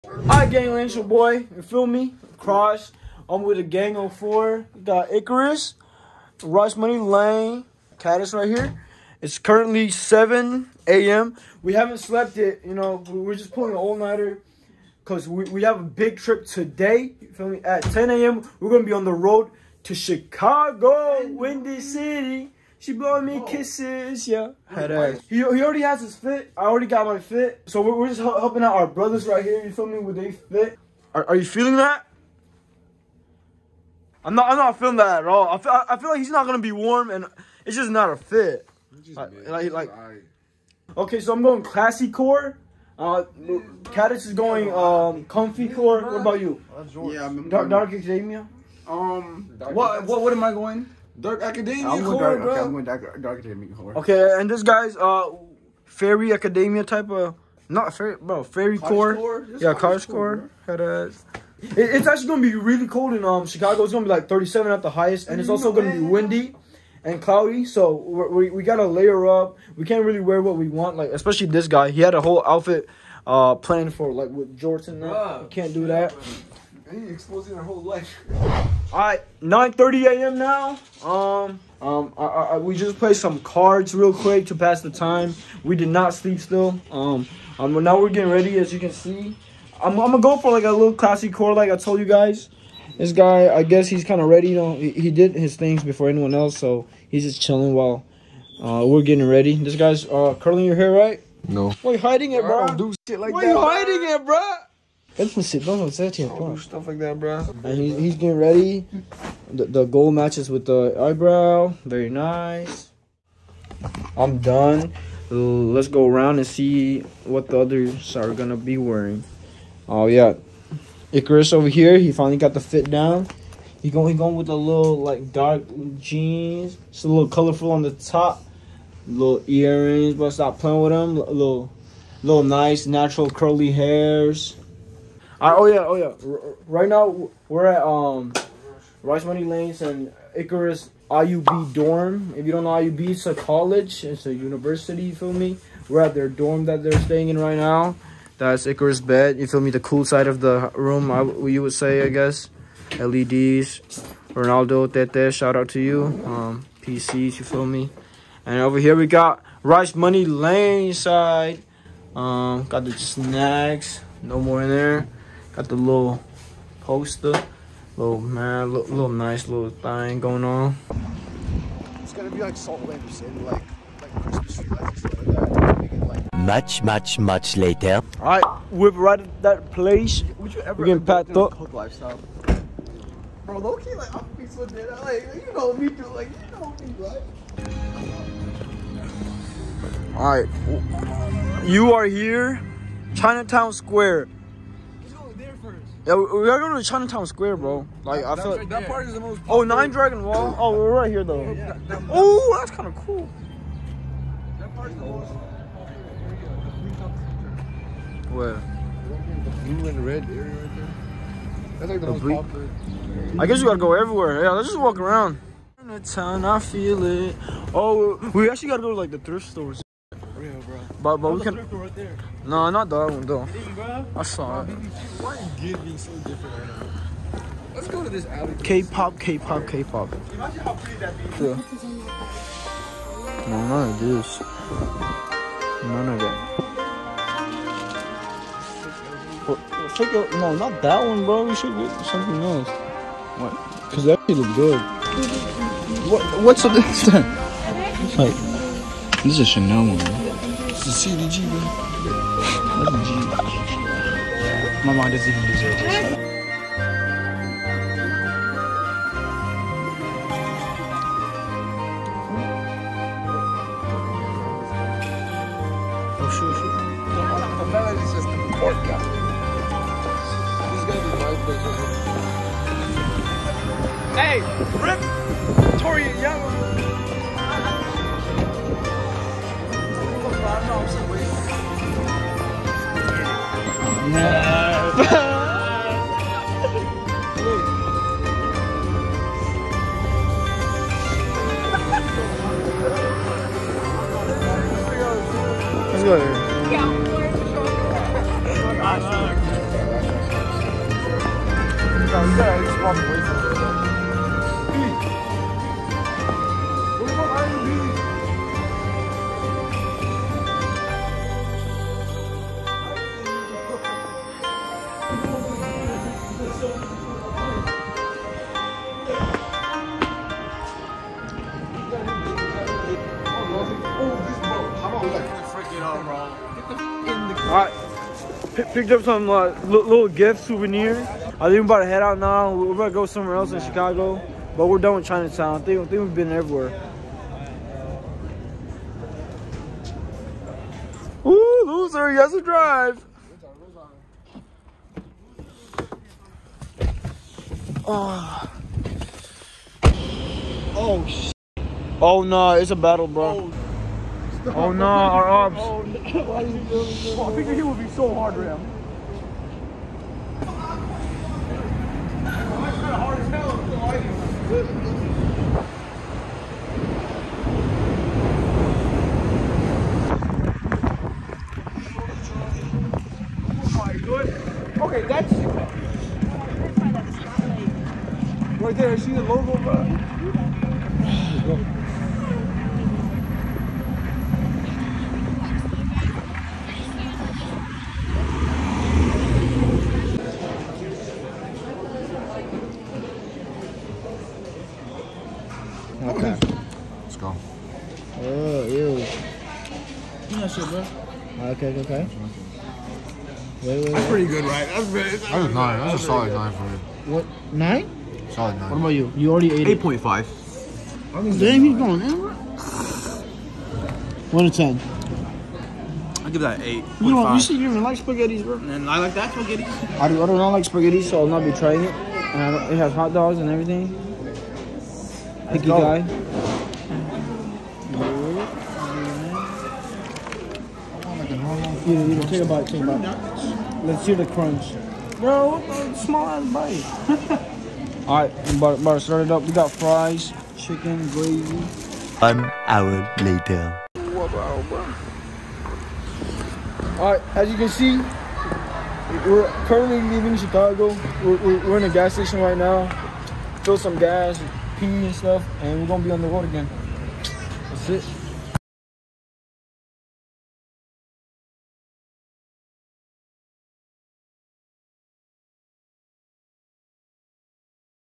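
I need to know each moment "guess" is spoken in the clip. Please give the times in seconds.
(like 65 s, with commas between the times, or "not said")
93 s, 152 s, 213 s.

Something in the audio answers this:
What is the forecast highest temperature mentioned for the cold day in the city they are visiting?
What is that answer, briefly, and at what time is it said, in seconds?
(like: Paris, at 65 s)
37, at 64 s.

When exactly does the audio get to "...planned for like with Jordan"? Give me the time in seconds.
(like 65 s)
73 s.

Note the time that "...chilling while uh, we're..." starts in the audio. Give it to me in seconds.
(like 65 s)
97 s.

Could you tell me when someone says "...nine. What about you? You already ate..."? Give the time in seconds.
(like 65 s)
408 s.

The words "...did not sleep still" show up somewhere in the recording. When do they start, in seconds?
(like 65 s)
85 s.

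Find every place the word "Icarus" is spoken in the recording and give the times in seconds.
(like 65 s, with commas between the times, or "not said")
5 s, 121 s, 140 s, 148 s.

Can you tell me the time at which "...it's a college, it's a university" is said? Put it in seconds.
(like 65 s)
143 s.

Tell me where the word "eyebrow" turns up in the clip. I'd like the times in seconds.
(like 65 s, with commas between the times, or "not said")
110 s.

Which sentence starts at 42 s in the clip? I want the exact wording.
Uh, Caddis is going um comfy core.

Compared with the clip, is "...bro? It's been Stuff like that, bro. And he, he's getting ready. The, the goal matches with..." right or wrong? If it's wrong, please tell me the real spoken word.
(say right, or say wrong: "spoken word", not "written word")
right.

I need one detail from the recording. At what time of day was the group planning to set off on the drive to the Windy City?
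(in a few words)
10 a.m.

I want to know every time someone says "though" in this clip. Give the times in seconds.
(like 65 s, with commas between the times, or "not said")
201 s, 223 s.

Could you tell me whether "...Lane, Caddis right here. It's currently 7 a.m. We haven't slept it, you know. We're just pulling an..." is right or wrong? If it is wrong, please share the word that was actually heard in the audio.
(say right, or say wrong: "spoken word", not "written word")
right.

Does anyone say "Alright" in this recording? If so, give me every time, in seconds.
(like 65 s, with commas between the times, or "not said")
78 s, 438 s, 446 s.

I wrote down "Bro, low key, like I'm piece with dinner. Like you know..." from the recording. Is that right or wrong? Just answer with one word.
right.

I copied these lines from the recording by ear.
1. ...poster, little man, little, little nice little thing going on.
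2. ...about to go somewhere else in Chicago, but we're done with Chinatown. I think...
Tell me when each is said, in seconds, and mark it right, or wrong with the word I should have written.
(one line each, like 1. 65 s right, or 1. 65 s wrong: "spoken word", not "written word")
1. 166 s right
2. 332 s right.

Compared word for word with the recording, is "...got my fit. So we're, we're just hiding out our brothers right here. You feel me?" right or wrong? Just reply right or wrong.
wrong.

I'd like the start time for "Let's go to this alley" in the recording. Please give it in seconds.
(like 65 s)
227 s.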